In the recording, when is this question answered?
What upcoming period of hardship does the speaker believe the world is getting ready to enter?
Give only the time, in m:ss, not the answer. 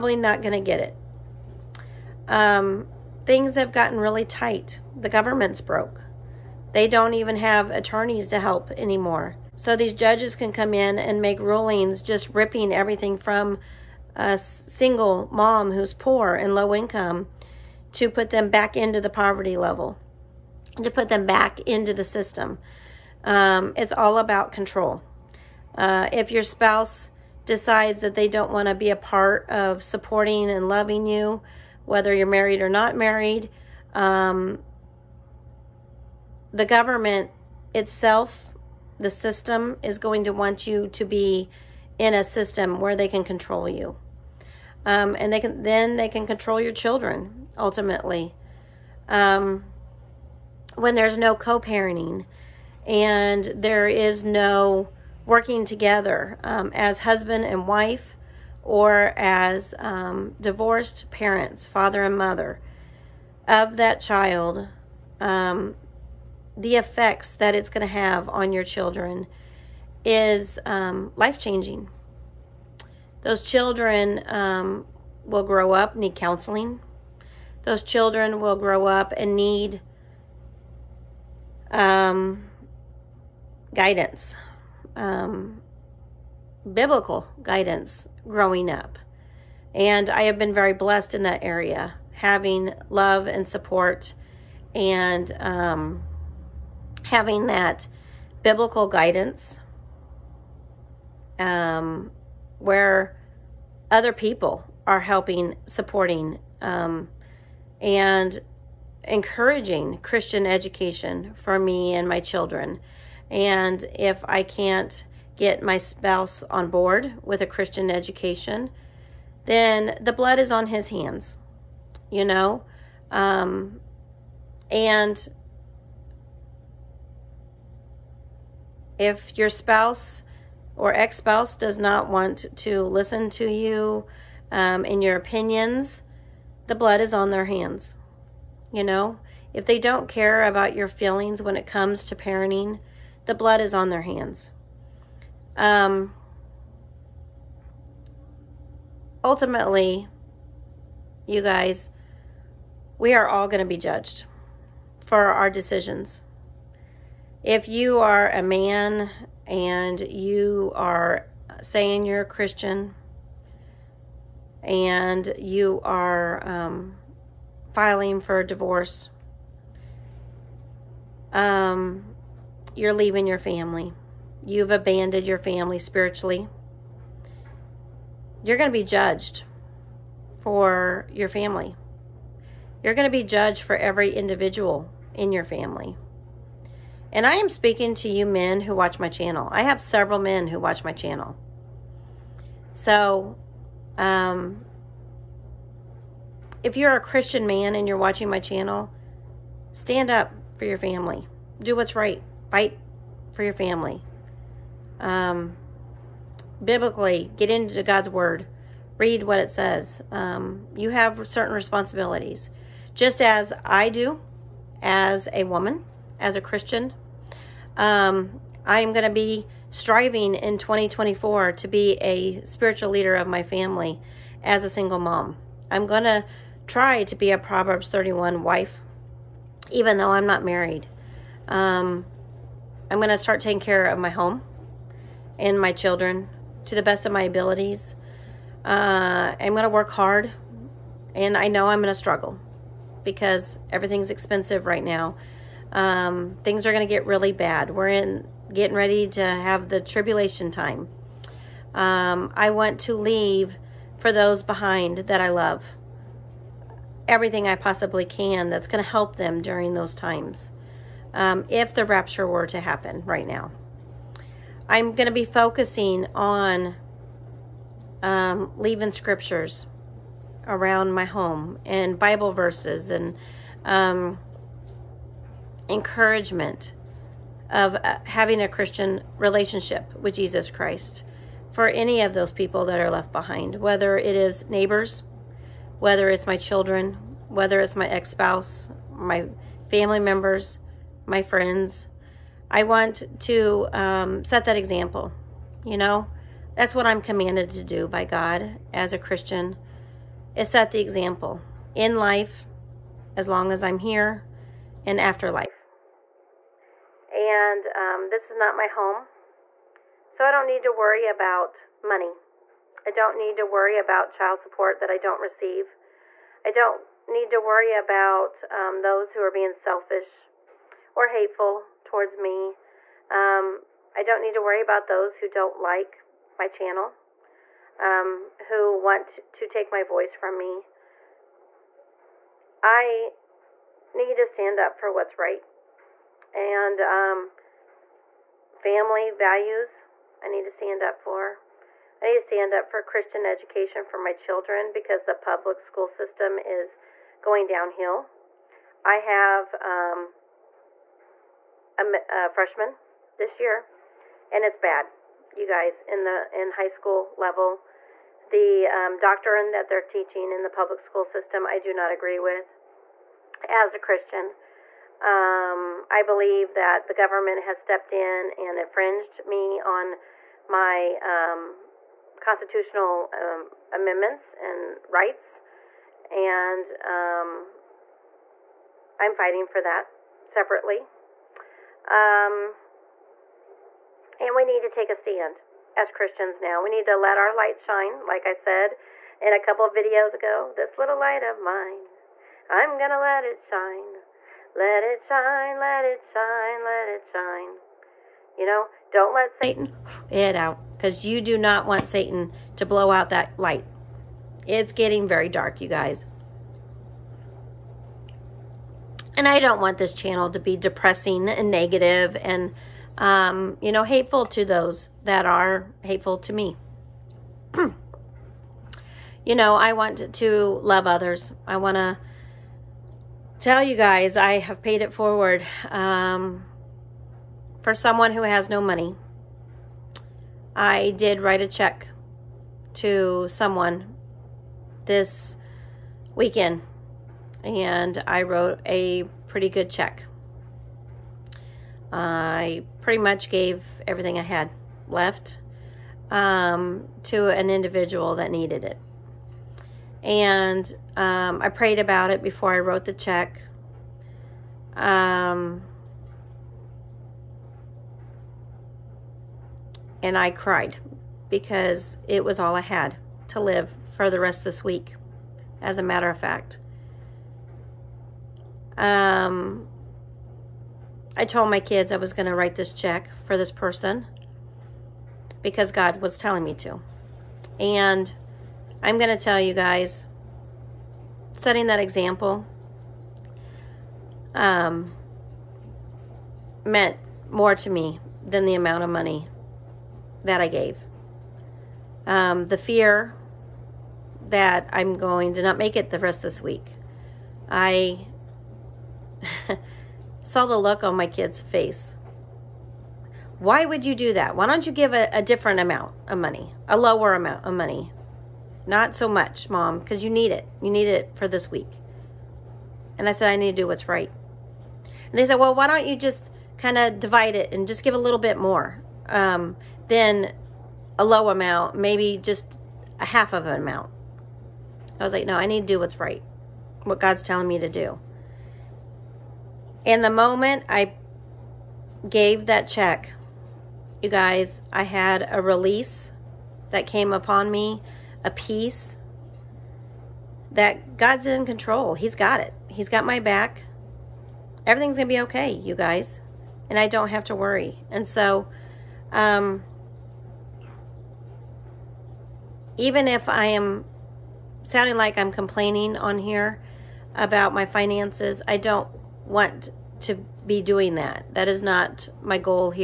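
4:09.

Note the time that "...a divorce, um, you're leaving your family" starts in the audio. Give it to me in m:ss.
2:48.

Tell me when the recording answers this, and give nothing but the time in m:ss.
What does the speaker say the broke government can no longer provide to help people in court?
0:07.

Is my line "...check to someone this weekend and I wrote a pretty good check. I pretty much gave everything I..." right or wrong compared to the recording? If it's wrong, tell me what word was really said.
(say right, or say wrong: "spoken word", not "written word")
right.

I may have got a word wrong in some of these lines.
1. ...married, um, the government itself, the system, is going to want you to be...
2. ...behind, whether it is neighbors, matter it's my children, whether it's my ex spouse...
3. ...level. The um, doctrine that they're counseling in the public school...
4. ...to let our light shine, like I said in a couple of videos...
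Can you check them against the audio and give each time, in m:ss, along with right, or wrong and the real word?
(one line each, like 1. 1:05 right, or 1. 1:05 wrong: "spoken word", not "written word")
1. 0:32 right
2. 4:43 wrong: "whether", not "matter"
3. 5:57 wrong: "teaching", not "counseling"
4. 6:26 right.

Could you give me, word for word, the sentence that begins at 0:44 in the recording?
Um, and they can then they can control your children ultimately.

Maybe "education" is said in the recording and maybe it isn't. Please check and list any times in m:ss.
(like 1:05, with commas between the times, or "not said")
1:50, 1:57, 5:43.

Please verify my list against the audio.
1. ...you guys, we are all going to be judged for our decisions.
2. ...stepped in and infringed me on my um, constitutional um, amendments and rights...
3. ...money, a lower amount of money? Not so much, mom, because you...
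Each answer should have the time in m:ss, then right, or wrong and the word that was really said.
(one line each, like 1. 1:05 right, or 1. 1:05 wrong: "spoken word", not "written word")
1. 2:31 right
2. 6:07 right
3. 8:26 right.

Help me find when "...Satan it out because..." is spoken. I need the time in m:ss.
6:39.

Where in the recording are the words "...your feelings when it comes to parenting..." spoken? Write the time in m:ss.
2:20.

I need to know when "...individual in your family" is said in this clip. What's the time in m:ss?
3:04.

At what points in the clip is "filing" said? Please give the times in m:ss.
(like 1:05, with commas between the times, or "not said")
2:47.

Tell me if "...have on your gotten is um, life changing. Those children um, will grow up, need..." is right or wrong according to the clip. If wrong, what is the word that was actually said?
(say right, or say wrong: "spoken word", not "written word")
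wrong: "children", not "gotten".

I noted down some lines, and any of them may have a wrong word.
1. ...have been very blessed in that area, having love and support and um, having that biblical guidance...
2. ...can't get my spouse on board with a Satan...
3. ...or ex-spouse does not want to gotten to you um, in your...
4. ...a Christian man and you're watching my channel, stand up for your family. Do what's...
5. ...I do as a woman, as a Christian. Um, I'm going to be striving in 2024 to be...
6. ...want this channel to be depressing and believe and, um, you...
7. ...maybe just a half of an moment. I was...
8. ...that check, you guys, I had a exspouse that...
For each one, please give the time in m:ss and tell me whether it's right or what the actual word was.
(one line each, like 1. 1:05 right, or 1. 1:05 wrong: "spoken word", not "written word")
1. 1:30 right
2. 1:54 wrong: "Christian", not "Satan"
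3. 2:10 wrong: "listen", not "gotten"
4. 3:16 right
5. 3:33 right
6. 6:49 wrong: "negative", not "believe"
7. 8:41 wrong: "amount", not "moment"
8. 8:52 wrong: "release", not "exspouse".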